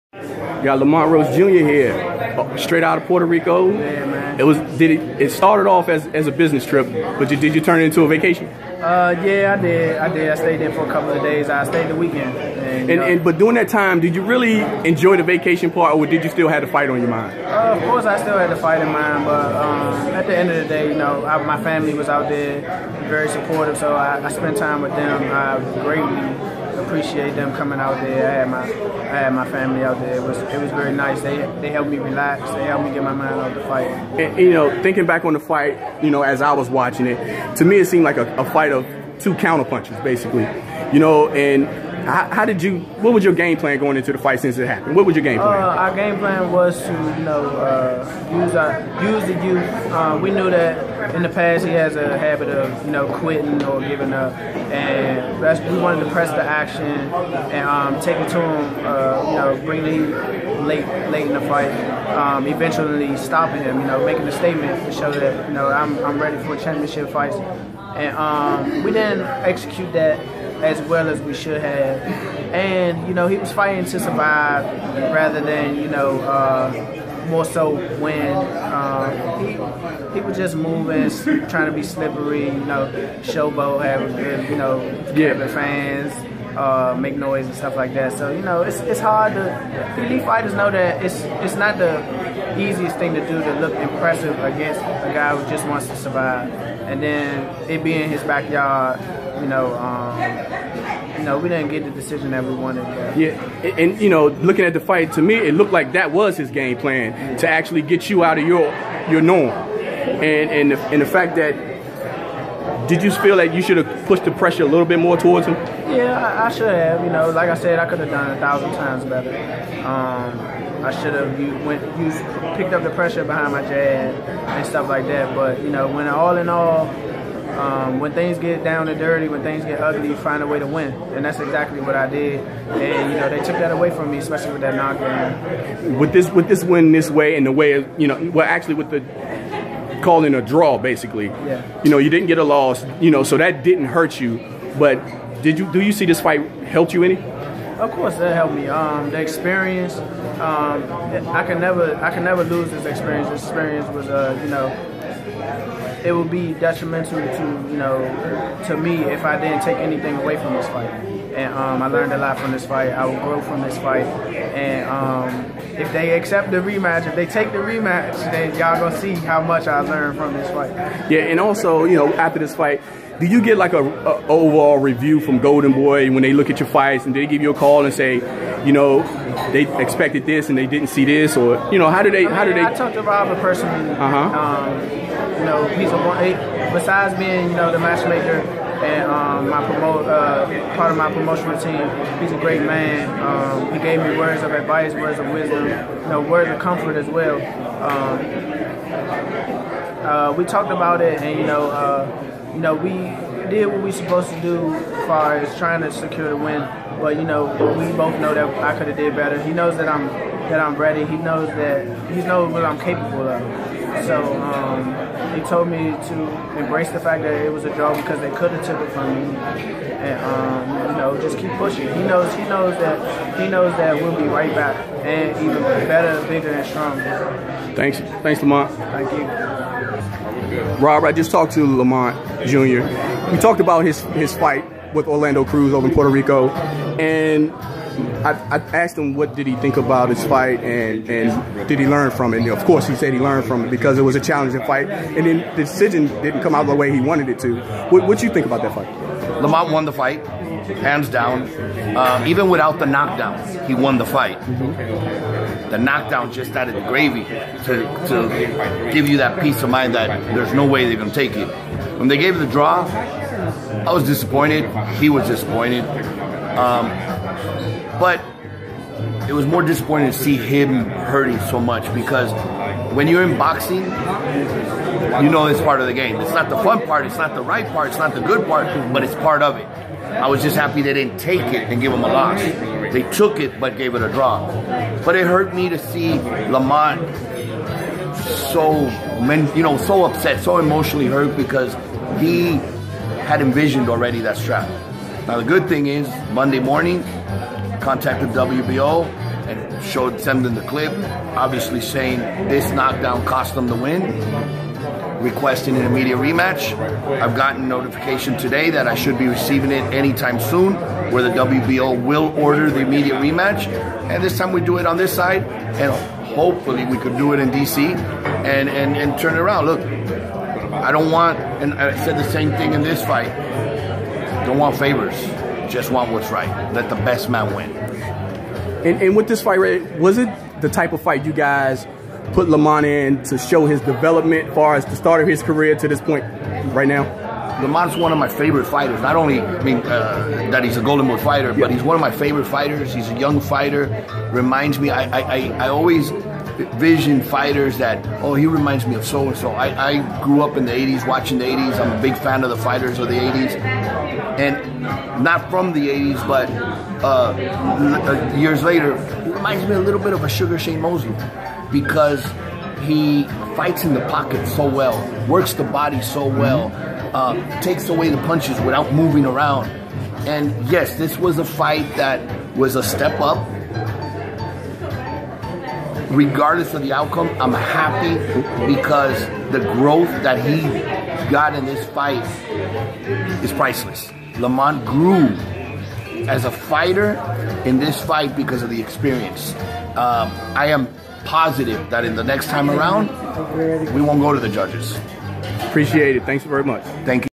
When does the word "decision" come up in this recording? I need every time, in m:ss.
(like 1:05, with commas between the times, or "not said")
1:41, 4:05.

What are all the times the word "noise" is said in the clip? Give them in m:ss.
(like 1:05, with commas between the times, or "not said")
1:27.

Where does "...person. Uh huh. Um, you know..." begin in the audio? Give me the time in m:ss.
3:03.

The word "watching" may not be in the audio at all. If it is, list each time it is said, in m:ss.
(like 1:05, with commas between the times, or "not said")
0:36, 5:51.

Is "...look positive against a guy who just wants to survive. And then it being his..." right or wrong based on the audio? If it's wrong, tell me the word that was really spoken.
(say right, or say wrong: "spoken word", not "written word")
wrong: "impressive", not "positive".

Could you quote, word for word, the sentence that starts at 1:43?
Yeah, and, and, you know, looking at the fight, to me, it looked like that was his game plan yeah.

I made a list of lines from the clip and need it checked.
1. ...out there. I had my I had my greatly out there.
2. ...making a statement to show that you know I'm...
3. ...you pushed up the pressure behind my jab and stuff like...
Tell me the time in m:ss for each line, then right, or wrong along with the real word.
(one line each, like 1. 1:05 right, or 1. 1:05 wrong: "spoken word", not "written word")
1. 0:27 wrong: "family", not "greatly"
2. 1:04 right
3. 2:01 wrong: "picked", not "pushed".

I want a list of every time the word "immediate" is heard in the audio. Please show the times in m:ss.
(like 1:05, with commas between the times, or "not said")
5:05, 5:12.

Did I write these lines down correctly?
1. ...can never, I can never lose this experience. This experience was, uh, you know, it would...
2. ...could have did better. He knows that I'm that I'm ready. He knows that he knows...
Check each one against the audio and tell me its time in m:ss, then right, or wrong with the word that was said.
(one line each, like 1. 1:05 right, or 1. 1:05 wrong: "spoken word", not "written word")
1. 2:31 right
2. 3:28 right.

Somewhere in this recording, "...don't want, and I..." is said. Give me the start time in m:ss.
5:20.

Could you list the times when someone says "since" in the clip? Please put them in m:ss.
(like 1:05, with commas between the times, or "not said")
0:44.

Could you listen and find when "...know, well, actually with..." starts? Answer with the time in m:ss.
2:18.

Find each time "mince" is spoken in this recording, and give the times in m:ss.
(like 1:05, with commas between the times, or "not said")
not said.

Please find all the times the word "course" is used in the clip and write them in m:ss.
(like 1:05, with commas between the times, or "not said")
0:17, 2:27, 4:02.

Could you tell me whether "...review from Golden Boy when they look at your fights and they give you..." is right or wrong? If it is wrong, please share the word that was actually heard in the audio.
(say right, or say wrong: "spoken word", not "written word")
right.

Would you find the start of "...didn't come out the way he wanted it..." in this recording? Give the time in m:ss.
4:06.